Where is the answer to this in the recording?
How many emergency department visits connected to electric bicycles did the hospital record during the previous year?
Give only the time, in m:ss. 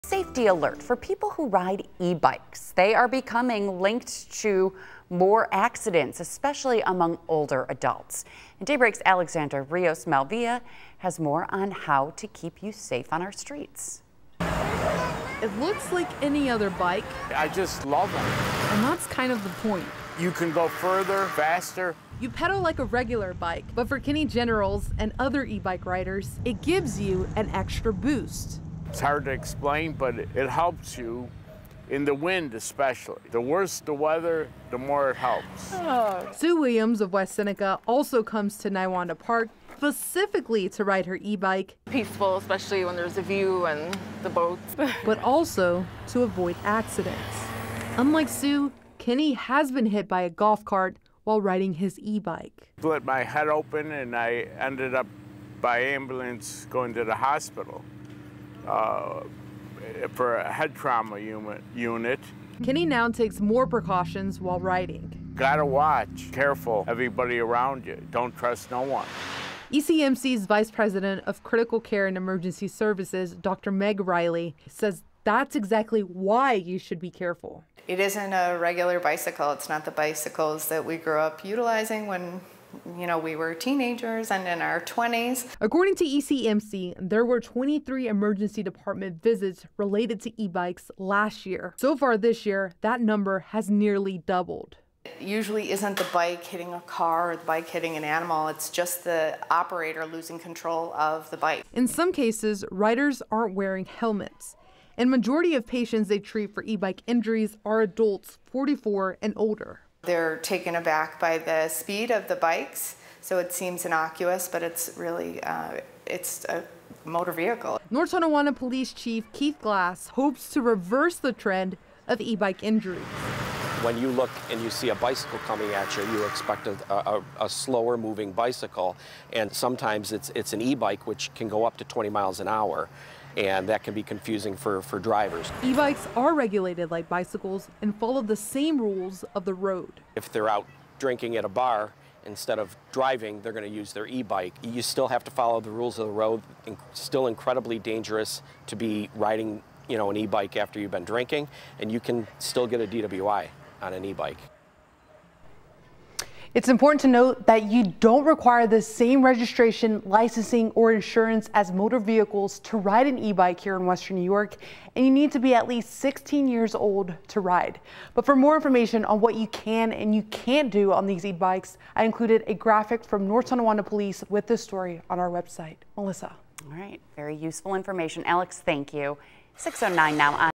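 1:27.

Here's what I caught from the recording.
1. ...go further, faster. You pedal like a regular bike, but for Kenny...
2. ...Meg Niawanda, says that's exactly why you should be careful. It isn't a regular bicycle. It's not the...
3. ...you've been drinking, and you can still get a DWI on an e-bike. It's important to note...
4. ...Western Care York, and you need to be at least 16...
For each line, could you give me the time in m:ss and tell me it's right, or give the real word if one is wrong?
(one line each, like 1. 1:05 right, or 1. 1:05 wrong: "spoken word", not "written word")
1. 0:20 right
2. 1:13 wrong: "Riley", not "Niawanda"
3. 2:30 right
4. 2:43 wrong: "New", not "Care".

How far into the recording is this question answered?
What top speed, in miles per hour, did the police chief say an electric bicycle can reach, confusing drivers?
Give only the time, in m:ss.
2:11.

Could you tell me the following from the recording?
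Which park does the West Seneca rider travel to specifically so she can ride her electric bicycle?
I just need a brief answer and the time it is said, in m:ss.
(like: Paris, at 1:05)
Niawanda Park, at 0:38.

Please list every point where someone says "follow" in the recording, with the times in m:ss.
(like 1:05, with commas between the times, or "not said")
2:17, 2:25.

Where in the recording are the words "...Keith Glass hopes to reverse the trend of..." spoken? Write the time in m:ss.
1:59.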